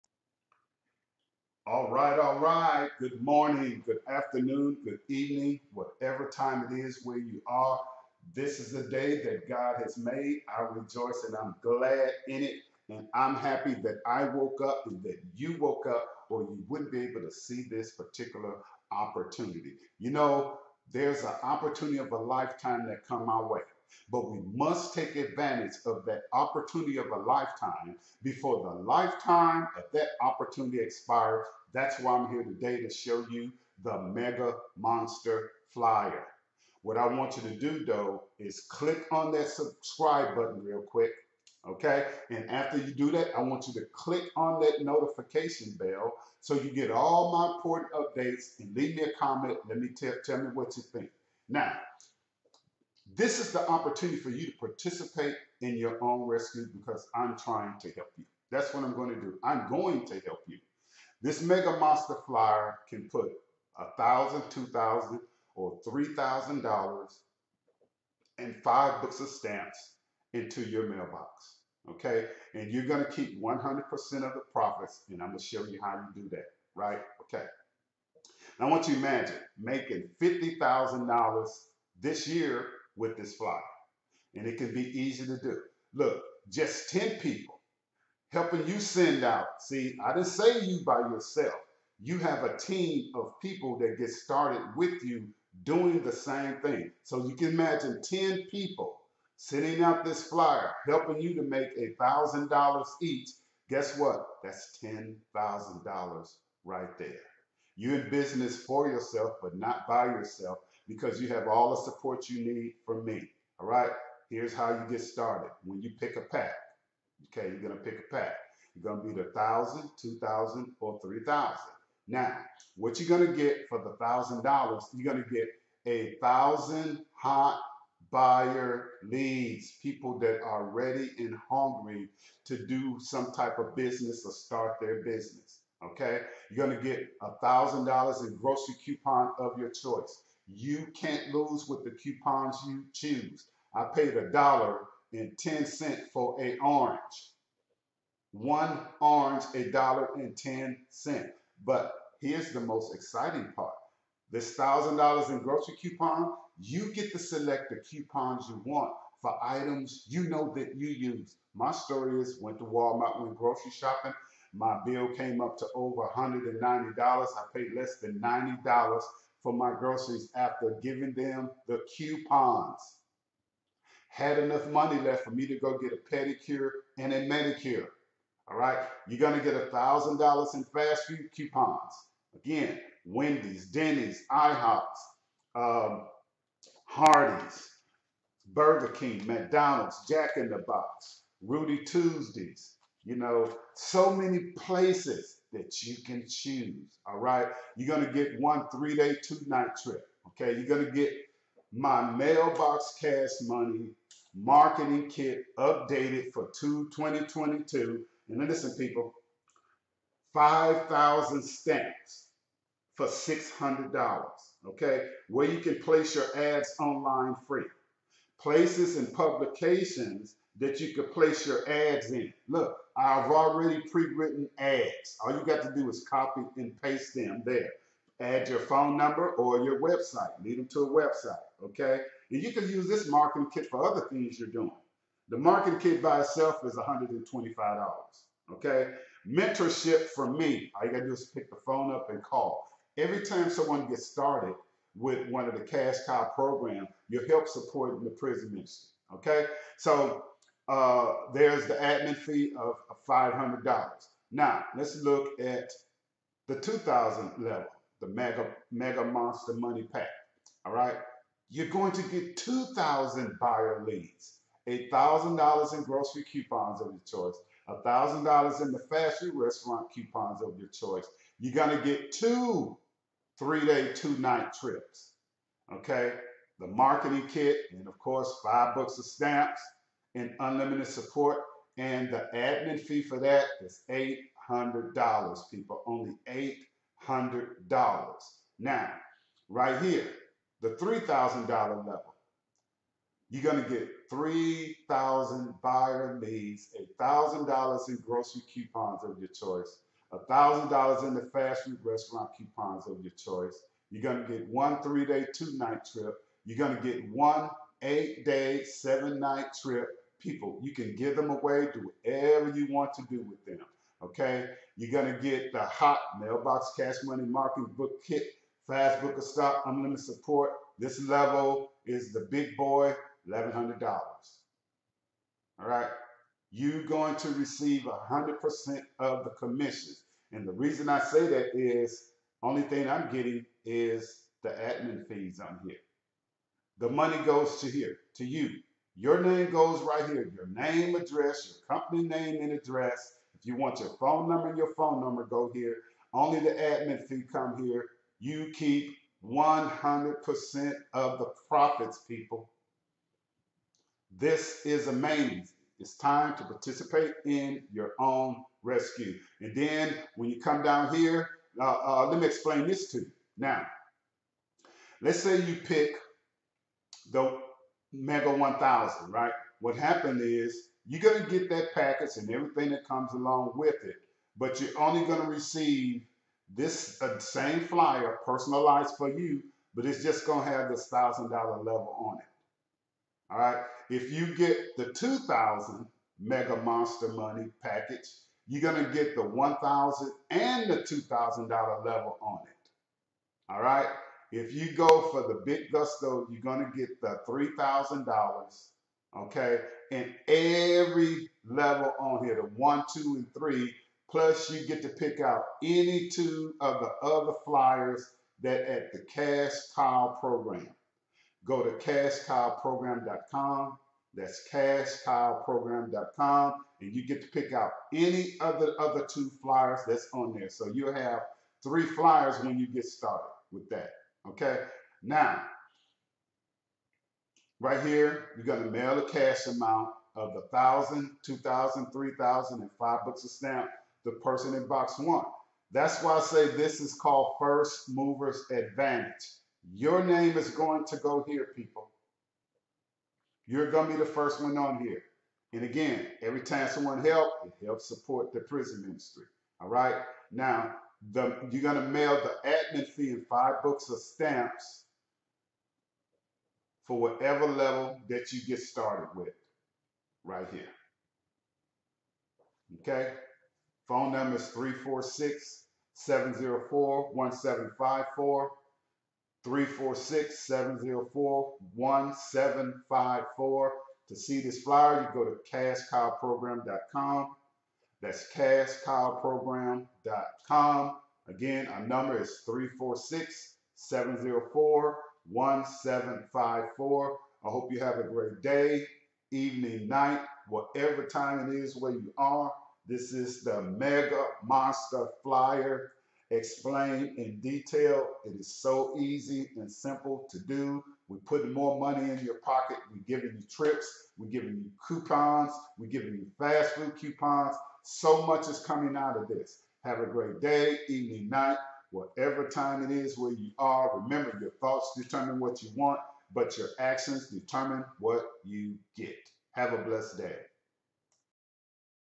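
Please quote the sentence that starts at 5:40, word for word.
Your name, address, your company name and address if you want your phone number, your phone number go here.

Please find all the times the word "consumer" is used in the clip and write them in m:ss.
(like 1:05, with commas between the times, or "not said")
not said.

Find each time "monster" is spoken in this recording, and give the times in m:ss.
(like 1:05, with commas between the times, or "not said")
0:34, 1:01, 4:19, 6:26, 8:14.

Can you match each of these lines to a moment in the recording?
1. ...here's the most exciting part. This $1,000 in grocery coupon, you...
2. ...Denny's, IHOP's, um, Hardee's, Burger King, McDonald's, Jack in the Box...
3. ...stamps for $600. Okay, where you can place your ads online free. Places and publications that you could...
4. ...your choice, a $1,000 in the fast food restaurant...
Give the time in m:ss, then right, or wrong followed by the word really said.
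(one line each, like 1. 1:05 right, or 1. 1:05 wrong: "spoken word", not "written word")
1. 2:32 right
2. 3:03 right
3. 3:31 right
4. 4:59 right.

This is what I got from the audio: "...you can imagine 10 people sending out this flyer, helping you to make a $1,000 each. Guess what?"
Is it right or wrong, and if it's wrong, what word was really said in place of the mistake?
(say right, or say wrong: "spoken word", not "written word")
right.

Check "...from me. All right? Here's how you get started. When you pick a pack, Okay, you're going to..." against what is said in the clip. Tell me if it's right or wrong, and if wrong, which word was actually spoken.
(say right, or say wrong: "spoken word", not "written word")
right.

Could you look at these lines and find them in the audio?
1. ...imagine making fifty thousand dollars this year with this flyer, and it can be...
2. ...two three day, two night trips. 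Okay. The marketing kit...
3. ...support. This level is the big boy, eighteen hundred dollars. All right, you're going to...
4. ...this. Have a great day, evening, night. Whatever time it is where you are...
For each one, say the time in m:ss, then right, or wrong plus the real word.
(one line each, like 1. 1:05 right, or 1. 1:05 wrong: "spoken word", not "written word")
1. 1:18 right
2. 4:32 right
3. 5:20 wrong: "eleven", not "eighteen"
4. 8:29 right.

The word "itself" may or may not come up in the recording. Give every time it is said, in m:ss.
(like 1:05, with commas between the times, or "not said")
3:56.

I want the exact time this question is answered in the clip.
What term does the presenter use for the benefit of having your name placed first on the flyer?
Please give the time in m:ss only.
7:17.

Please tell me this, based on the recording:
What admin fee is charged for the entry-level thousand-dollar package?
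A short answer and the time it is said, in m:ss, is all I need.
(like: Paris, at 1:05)
$500, at 4:13.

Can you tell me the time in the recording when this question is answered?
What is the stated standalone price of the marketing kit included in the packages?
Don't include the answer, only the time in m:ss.
3:56.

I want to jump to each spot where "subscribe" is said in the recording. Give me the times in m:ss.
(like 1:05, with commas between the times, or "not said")
0:39.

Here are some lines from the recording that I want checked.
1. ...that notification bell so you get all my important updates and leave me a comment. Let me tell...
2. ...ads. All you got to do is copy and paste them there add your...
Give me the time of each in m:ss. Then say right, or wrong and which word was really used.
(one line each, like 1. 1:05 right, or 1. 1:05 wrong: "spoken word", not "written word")
1. 0:44 right
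2. 3:44 right.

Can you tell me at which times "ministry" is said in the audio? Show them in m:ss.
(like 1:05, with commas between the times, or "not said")
4:08, 7:28.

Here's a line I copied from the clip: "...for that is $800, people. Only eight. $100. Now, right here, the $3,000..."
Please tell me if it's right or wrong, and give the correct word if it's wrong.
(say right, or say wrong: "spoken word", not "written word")
right.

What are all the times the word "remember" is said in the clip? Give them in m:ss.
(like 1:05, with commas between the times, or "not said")
8:33.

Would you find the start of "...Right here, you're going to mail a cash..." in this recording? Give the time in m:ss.
7:07.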